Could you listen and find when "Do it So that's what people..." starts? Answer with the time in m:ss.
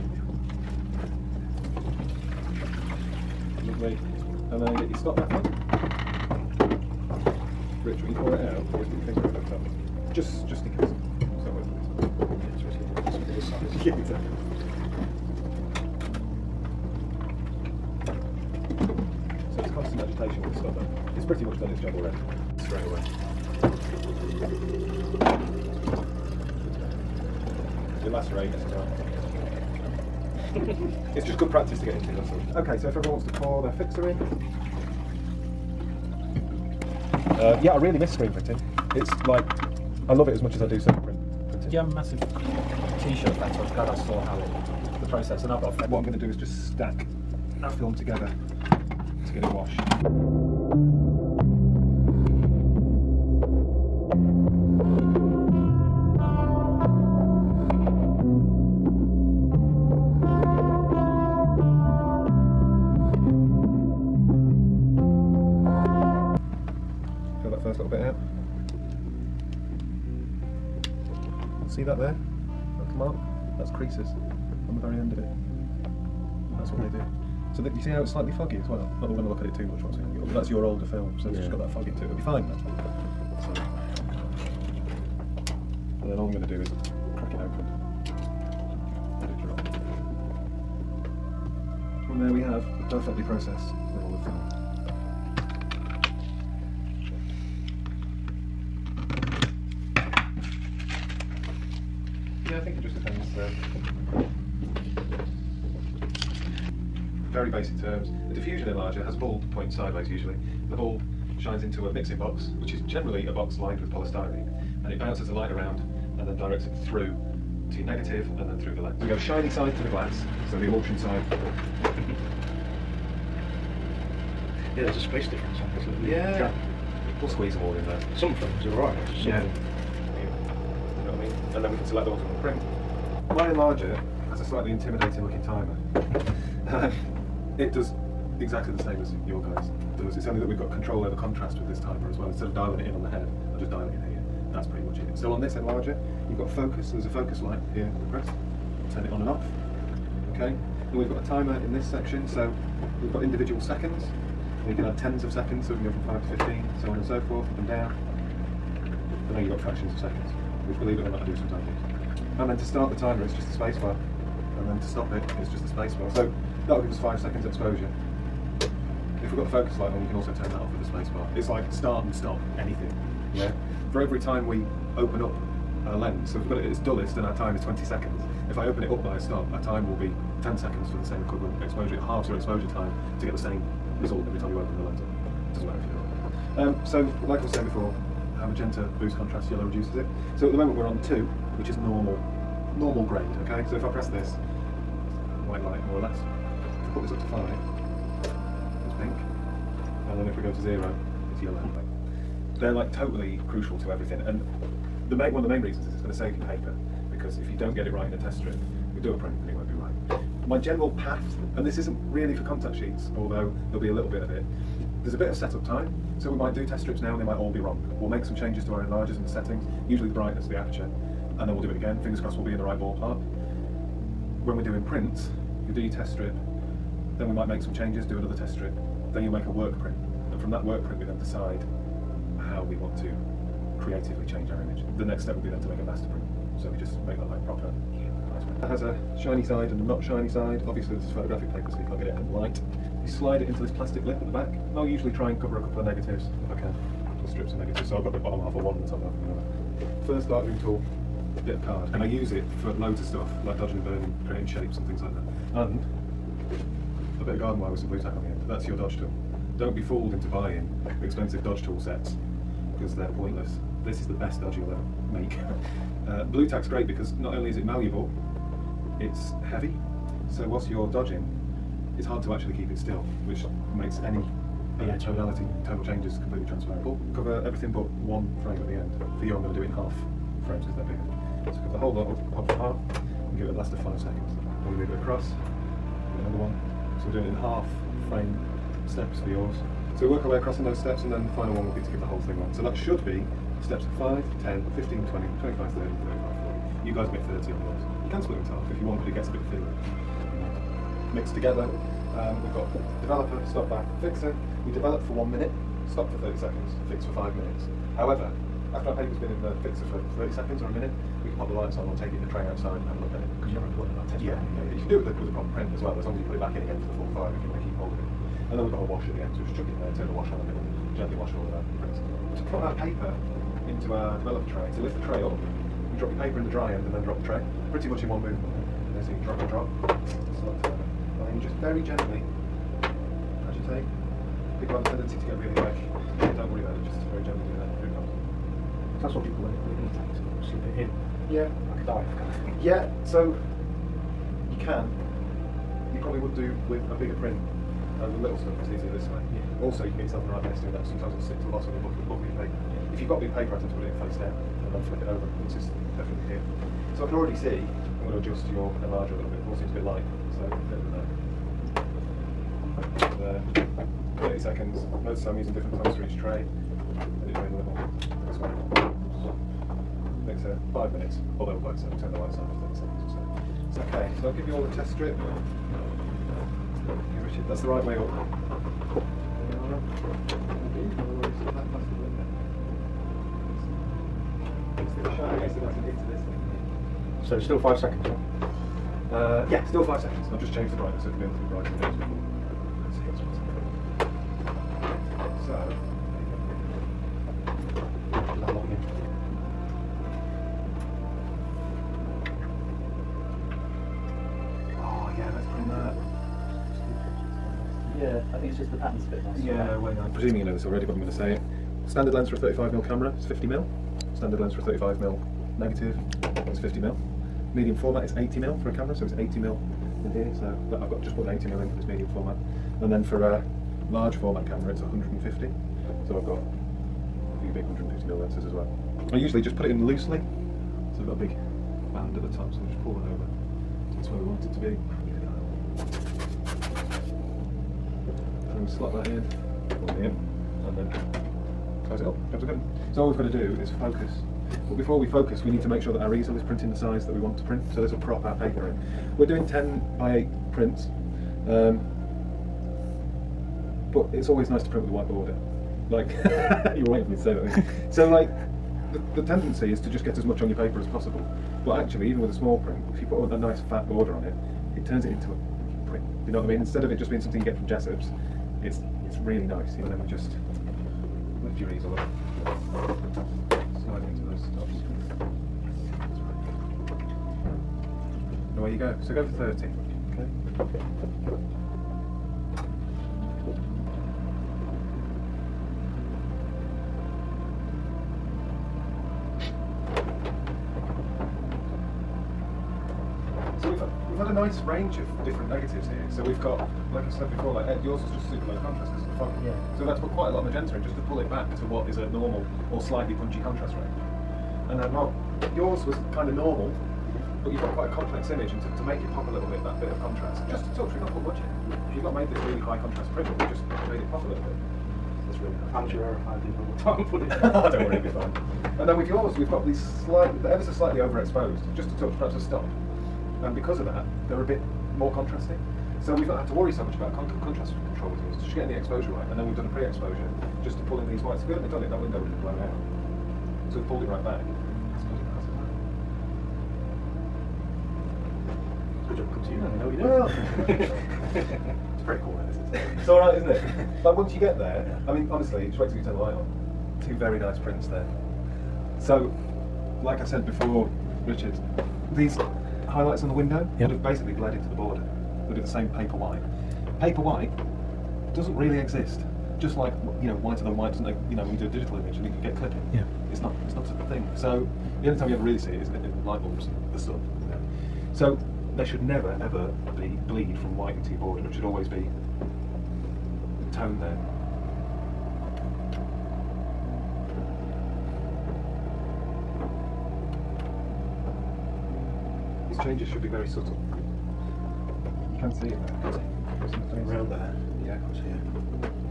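5:37.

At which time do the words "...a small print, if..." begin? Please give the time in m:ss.
7:42.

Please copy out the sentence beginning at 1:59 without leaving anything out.
we go shiny side to the glass, so the emulsion side.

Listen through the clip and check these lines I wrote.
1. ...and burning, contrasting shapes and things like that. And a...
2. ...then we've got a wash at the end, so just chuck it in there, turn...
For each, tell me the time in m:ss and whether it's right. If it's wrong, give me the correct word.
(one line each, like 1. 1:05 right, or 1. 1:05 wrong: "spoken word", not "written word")
1. 4:13 wrong: "creating", not "contrasting"
2. 5:18 right.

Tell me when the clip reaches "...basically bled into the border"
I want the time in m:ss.
9:14.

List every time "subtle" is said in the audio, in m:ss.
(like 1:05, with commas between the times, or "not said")
9:43.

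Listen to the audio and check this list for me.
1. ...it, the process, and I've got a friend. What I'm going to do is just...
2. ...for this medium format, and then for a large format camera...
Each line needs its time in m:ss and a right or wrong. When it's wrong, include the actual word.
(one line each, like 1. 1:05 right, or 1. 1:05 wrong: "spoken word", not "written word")
1. 0:44 right
2. 7:01 right.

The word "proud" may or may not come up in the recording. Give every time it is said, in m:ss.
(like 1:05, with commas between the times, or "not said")
not said.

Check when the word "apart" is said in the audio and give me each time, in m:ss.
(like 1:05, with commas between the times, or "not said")
4:42.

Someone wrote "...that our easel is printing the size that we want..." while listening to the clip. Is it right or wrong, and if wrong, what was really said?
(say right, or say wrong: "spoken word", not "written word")
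right.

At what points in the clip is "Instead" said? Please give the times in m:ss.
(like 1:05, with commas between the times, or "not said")
2:22, 7:46.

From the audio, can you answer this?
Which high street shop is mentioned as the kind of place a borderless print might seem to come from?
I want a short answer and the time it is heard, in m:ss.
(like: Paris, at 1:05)
Jessops, at 7:47.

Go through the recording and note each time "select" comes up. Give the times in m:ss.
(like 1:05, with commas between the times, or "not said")
2:11, 5:30.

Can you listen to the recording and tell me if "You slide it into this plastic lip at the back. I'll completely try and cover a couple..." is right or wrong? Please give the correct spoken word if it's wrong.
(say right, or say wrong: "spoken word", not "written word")
wrong: "usually", not "completely".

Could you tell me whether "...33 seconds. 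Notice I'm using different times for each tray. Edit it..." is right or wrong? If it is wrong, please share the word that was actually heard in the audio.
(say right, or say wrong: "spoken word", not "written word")
wrong: "30", not "33".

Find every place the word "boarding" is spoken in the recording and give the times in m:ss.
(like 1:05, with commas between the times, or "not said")
not said.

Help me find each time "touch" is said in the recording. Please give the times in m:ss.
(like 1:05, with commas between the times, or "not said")
8:30, 8:42.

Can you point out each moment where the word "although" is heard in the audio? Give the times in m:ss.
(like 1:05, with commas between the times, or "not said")
3:33, 6:11.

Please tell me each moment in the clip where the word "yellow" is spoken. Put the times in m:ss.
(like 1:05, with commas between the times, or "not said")
3:09, 3:21.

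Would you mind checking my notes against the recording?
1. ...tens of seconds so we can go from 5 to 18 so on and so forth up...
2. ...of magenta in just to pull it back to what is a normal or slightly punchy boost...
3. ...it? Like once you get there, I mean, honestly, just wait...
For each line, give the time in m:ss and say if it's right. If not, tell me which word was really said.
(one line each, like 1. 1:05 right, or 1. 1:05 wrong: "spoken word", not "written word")
1. 2:34 wrong: "15", not "18"
2. 8:20 wrong: "contrast", not "boost"
3. 9:03 right.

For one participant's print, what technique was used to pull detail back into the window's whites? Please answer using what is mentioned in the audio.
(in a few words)
pre-exposure.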